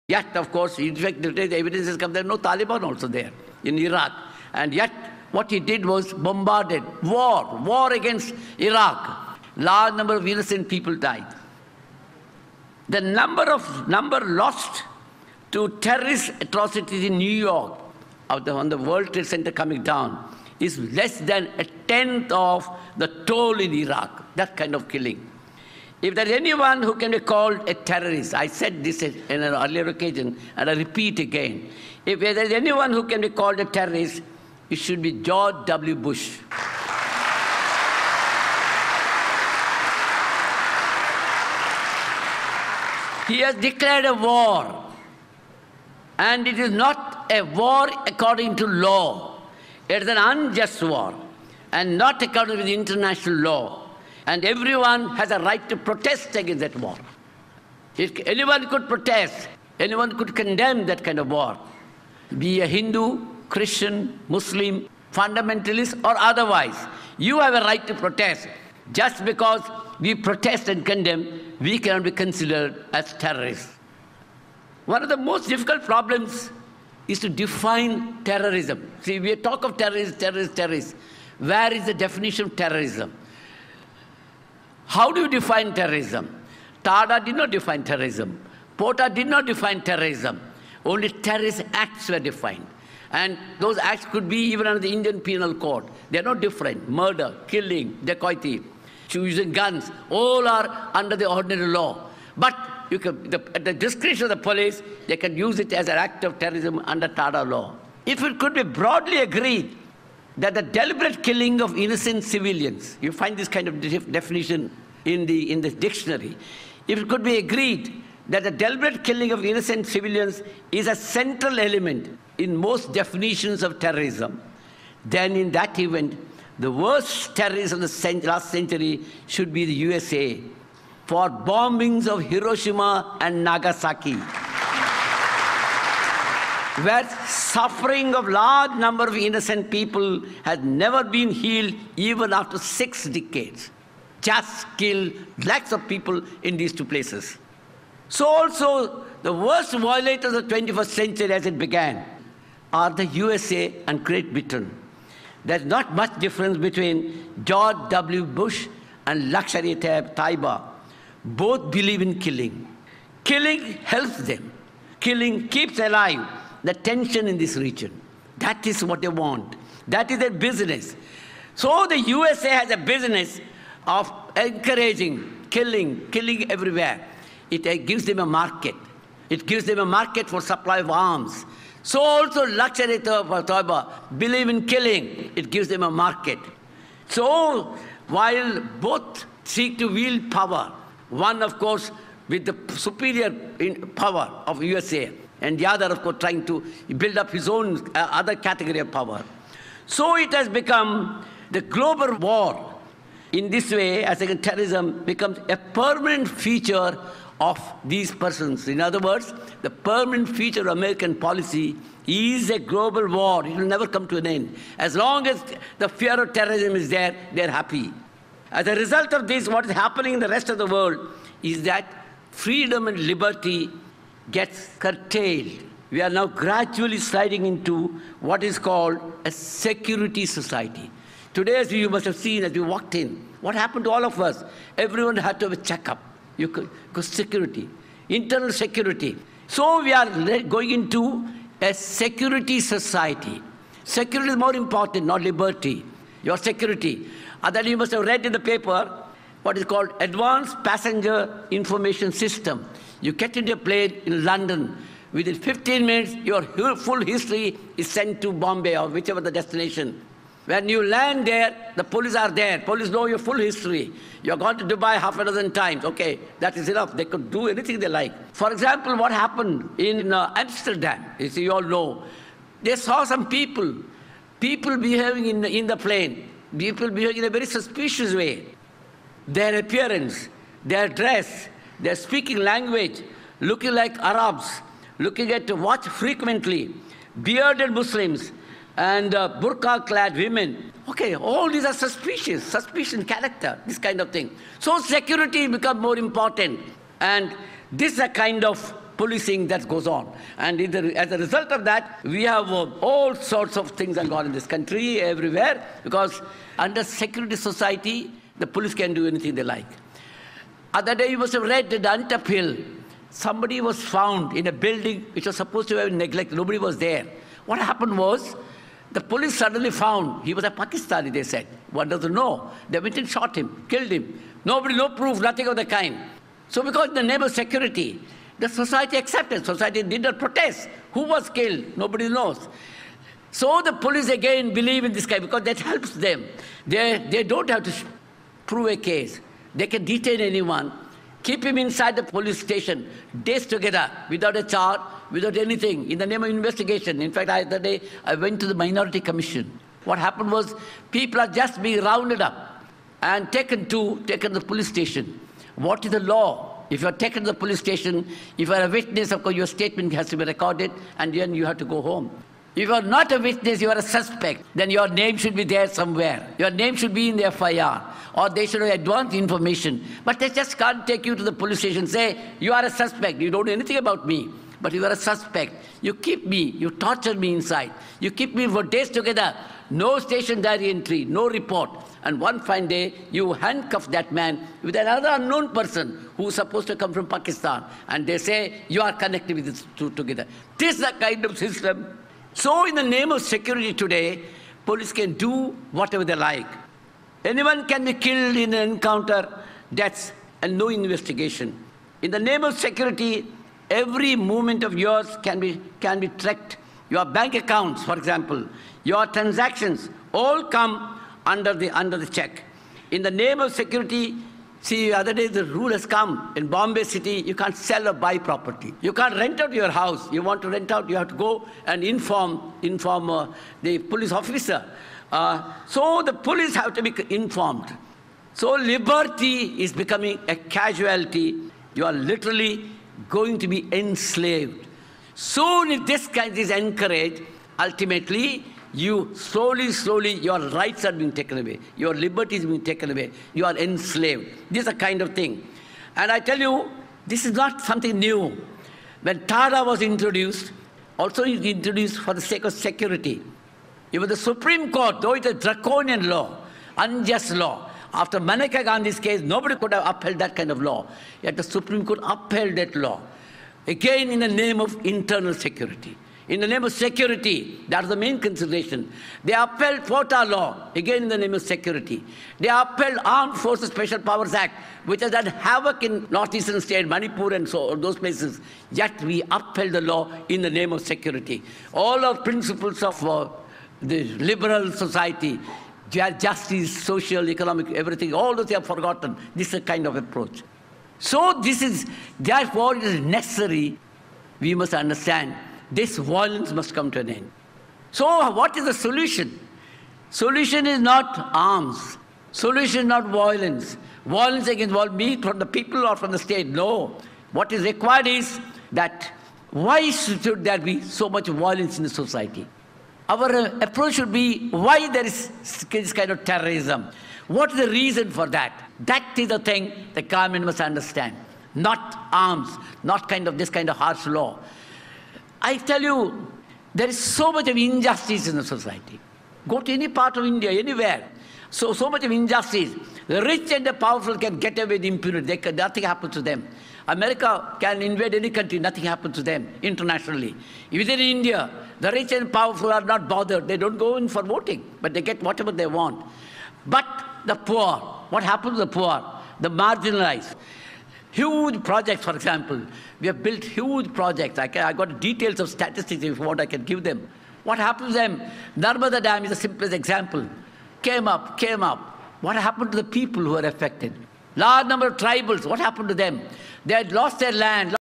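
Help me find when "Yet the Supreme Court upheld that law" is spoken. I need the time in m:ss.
7:41.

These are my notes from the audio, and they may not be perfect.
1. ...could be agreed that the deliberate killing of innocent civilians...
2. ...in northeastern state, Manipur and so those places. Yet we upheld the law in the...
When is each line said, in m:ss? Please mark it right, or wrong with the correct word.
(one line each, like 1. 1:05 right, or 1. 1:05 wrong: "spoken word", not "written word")
1. 1:57 right
2. 7:55 right.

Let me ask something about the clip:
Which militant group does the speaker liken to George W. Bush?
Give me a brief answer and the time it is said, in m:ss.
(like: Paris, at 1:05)
Lashkar-e-Taiba, at 2:39.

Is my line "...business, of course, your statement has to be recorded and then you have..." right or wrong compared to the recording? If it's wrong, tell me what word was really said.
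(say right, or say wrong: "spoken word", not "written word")
wrong: "witness", not "business".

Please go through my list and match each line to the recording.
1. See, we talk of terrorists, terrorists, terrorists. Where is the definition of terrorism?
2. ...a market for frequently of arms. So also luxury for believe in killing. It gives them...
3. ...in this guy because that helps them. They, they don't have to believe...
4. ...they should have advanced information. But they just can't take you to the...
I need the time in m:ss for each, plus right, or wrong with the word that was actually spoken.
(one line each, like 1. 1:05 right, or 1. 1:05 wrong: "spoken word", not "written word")
1. 1:19 right
2. 2:59 wrong: "supply", not "frequently"
3. 5:34 wrong: "prove", not "believe"
4. 6:08 right.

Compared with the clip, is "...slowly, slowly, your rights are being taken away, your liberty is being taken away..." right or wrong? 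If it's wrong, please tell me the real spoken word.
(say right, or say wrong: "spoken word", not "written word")
right.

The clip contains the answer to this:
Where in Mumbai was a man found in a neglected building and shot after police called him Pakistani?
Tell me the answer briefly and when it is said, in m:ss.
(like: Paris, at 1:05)
Antop Hill, at 5:11.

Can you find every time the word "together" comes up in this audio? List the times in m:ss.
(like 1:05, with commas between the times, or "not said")
5:43, 6:18, 6:29.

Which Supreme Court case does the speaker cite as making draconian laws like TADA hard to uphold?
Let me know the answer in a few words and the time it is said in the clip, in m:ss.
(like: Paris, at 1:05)
Maneka Gandhi's case, at 7:38.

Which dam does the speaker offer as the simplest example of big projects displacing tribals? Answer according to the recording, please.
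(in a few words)
Narmada Dam.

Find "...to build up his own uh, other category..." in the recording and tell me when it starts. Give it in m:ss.
3:16.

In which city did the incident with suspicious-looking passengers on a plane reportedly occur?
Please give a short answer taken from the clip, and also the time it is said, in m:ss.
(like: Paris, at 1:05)
Amsterdam, at 4:30.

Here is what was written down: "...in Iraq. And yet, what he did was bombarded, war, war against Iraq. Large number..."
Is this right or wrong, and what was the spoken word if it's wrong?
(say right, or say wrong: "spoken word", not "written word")
right.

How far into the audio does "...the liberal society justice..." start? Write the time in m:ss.
8:03.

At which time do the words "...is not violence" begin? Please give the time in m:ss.
8:22.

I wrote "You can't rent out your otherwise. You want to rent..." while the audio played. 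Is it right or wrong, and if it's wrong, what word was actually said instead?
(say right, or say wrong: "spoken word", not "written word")
wrong: "house", not "otherwise".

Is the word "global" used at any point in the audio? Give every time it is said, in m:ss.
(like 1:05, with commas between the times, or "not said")
3:21, 3:32.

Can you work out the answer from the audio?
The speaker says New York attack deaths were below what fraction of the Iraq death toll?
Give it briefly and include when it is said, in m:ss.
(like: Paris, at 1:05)
a tenth, at 0:21.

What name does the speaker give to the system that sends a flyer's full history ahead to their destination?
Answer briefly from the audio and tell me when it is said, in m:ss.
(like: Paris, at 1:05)
Advanced Passenger Information System, at 4:10.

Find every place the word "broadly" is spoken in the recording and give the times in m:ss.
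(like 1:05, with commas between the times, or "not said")
1:48.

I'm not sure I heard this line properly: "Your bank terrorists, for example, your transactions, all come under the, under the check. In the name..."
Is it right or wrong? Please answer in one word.
wrong.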